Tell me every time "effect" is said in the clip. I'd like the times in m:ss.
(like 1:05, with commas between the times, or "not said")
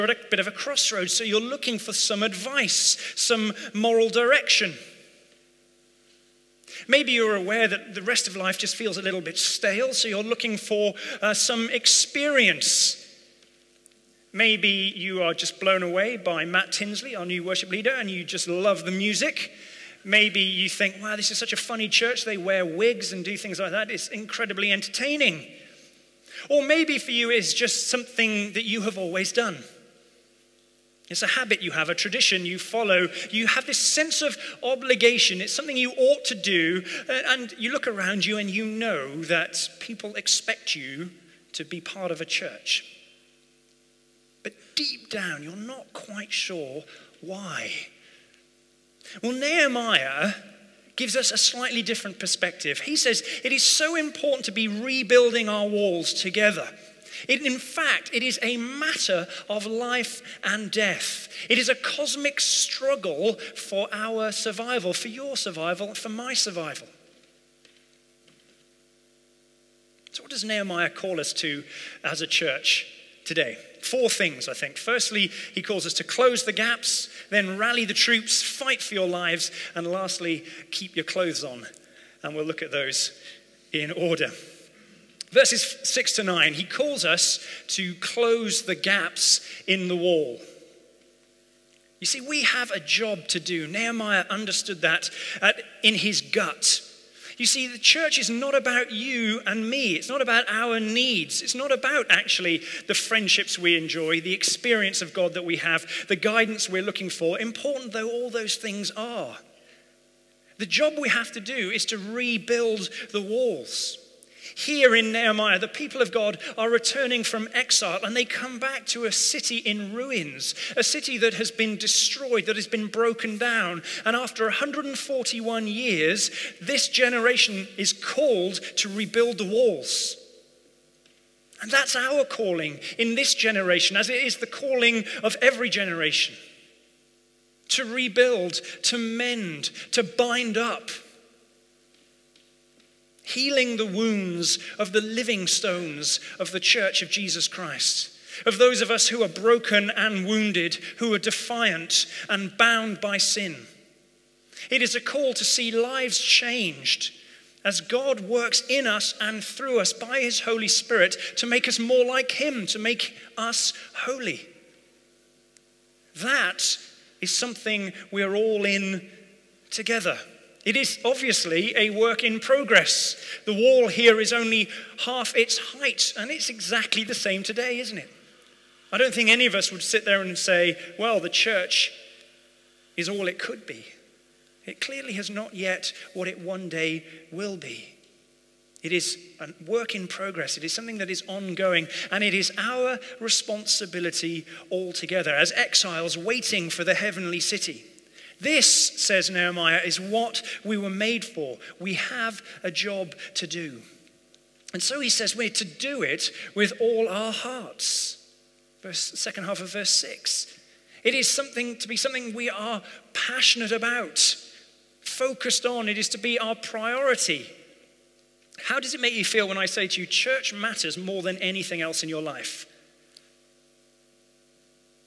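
not said.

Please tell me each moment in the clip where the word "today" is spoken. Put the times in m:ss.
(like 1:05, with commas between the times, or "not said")
1:13, 2:57.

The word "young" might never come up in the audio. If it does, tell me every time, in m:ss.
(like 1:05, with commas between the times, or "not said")
not said.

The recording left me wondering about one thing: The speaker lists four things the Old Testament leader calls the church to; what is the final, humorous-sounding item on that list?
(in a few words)
Keep your clothes on.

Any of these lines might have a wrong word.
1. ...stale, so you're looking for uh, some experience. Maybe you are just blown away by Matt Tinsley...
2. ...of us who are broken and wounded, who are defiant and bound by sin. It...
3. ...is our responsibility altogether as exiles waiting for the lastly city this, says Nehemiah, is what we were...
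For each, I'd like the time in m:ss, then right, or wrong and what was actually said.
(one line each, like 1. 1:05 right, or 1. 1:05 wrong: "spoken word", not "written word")
1. 0:09 right
2. 2:28 right
3. 3:12 wrong: "heavenly", not "lastly".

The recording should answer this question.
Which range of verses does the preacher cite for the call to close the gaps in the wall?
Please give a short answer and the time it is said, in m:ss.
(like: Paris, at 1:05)
Verses 6 to 9, at 1:25.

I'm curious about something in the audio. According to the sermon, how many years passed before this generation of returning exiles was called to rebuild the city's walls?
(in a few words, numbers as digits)
141.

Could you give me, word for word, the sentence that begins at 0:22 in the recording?
They wear wigs and do things like that.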